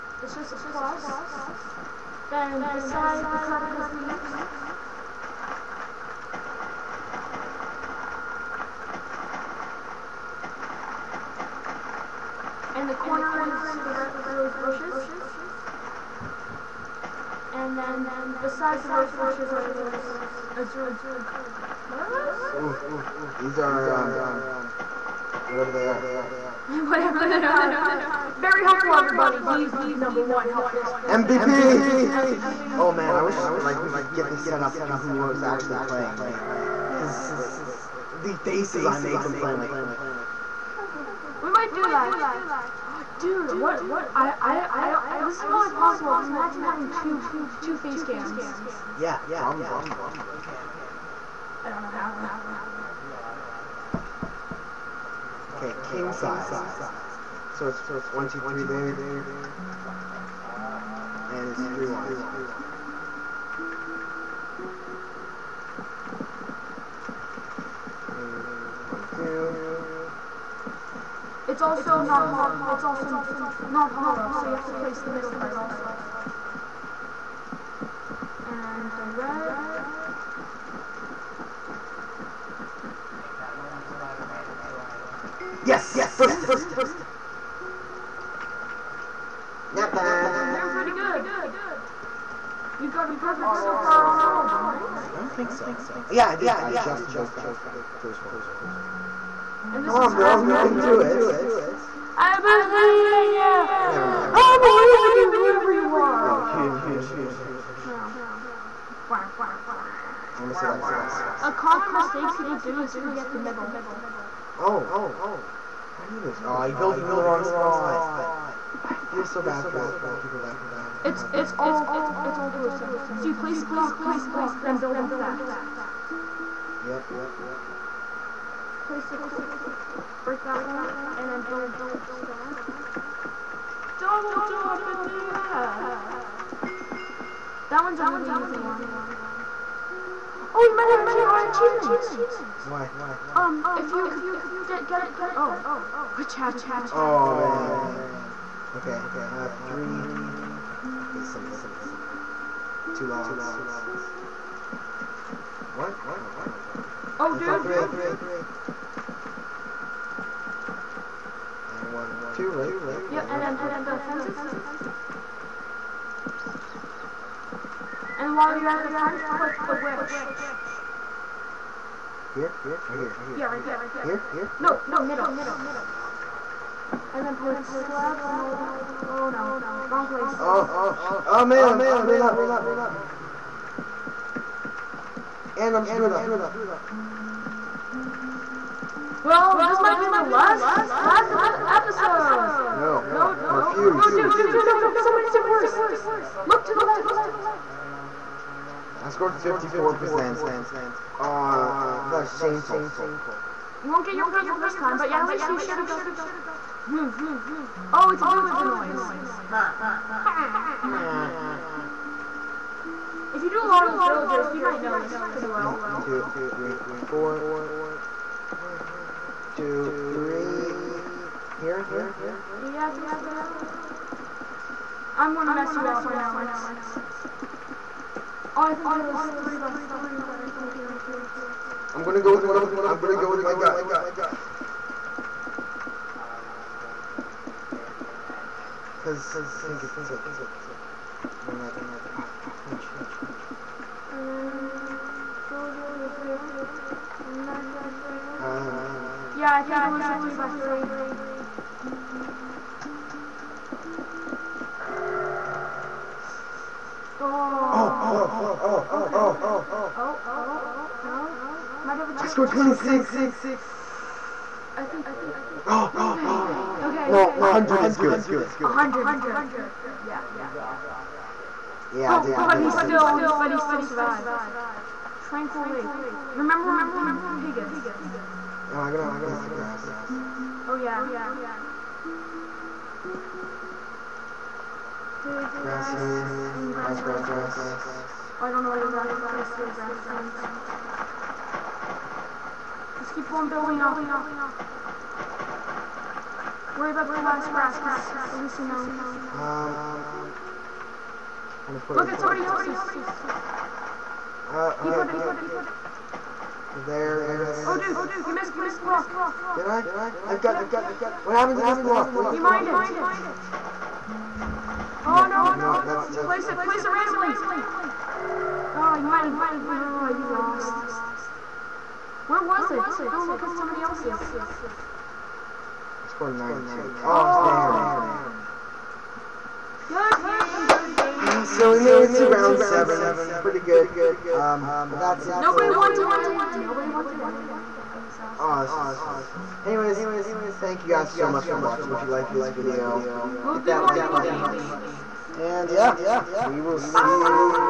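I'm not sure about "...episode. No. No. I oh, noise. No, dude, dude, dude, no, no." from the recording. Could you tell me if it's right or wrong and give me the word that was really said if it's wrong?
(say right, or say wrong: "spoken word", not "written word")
wrong: "refuse", not "noise".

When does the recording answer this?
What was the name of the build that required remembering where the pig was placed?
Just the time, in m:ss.
4:35.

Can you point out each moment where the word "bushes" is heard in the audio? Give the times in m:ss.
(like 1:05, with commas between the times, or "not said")
0:14, 0:19.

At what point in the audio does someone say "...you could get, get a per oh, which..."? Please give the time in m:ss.
2:23.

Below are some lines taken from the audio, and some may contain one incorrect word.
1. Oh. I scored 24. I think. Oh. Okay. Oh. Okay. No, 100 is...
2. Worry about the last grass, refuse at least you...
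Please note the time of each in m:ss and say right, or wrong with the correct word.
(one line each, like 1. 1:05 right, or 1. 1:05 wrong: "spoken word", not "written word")
1. 4:21 wrong: "26", not "24"
2. 4:56 wrong: "cause", not "refuse".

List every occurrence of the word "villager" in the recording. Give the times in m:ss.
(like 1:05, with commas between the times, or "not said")
3:28, 3:34.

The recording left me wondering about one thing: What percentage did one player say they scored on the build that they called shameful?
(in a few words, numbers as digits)
54%.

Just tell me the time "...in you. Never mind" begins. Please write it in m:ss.
1:43.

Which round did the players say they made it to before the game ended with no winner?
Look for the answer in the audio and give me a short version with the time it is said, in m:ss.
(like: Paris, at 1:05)
Round 7, at 5:32.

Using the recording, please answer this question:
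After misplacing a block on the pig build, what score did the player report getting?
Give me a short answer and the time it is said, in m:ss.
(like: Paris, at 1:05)
92, at 5:26.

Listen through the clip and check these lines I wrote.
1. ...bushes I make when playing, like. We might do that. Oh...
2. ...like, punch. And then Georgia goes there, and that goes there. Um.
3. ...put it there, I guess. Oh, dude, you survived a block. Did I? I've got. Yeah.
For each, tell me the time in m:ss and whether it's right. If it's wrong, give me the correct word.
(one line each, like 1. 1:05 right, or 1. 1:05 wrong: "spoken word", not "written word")
1. 0:38 wrong: "faces", not "bushes"
2. 4:01 right
3. 5:04 wrong: "misplaced", not "survived".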